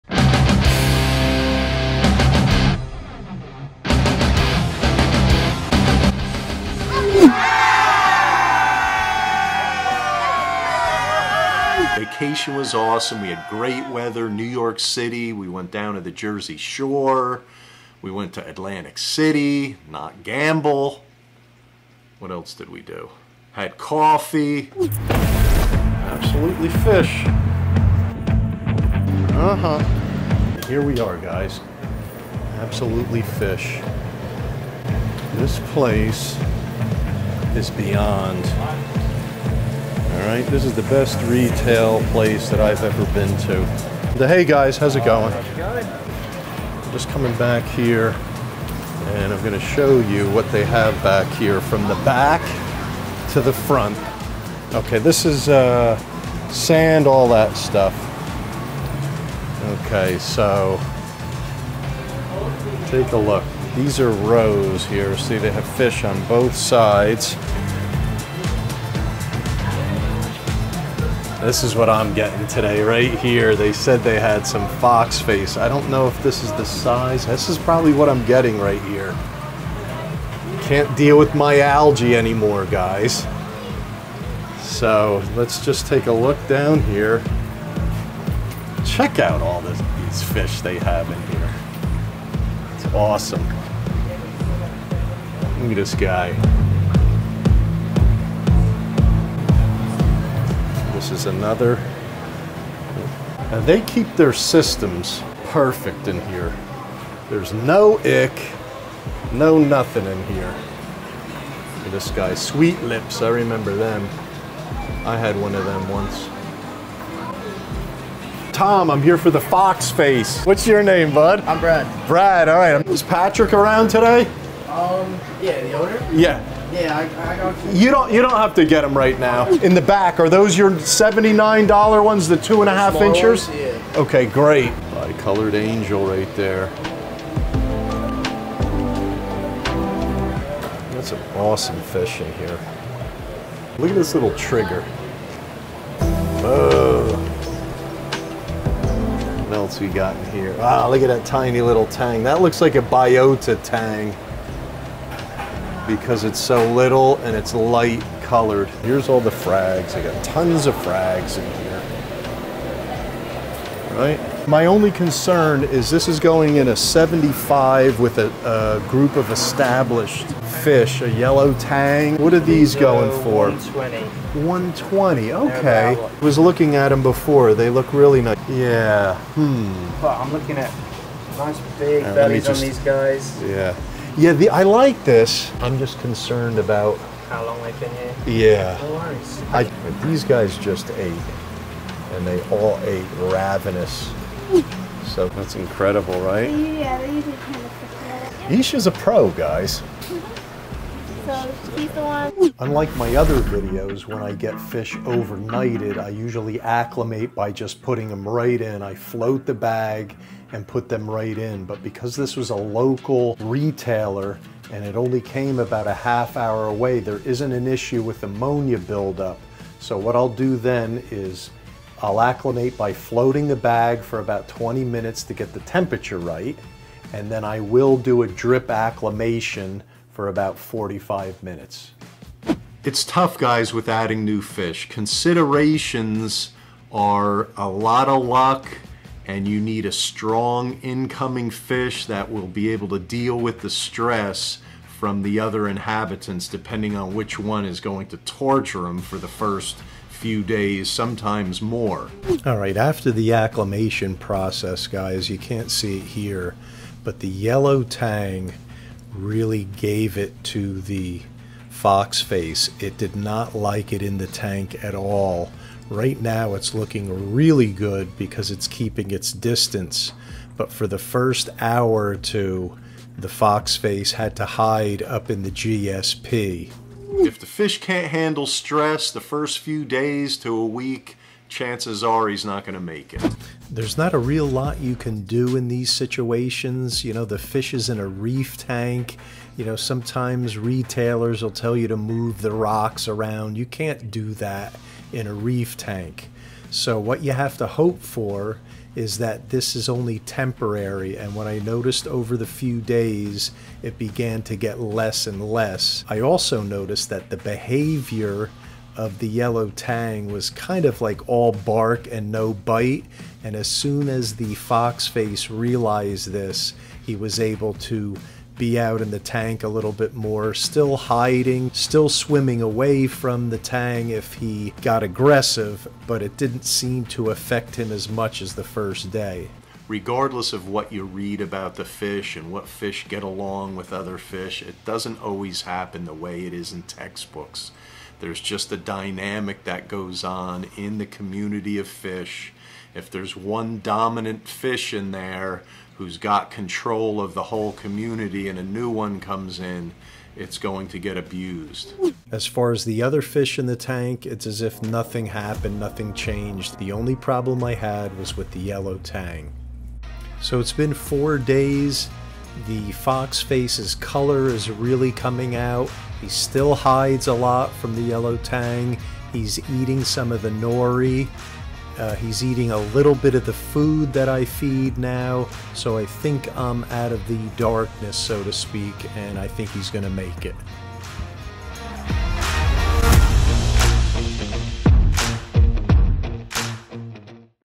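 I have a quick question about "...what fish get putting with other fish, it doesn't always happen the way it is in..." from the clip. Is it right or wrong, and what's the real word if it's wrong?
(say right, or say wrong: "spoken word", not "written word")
wrong: "along", not "putting".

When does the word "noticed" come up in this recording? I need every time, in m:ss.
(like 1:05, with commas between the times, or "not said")
5:01, 5:06.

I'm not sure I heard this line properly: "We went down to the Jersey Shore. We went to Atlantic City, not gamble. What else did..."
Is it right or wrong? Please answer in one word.
right.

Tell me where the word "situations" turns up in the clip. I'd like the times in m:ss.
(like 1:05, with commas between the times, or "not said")
4:45.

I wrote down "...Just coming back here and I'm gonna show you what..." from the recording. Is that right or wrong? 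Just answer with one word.
right.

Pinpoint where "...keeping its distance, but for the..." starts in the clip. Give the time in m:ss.
4:28.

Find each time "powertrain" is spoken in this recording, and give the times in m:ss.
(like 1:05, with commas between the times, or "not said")
not said.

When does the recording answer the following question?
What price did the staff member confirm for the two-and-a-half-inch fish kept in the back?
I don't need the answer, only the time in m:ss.
2:10.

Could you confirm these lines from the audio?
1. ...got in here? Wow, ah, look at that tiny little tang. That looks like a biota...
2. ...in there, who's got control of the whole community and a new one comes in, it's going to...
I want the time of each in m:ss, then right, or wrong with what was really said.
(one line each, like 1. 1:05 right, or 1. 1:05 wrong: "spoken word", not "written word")
1. 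2:29 right
2. 5:44 right.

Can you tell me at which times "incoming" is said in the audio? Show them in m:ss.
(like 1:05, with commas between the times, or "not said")
4:00.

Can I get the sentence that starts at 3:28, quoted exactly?
I float the bag and put them right in.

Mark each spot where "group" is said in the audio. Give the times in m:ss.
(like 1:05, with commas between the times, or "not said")
2:48.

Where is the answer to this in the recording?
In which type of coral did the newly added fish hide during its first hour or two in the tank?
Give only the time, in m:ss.
4:35.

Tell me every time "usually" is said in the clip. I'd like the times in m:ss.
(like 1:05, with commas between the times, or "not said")
3:17, 3:26.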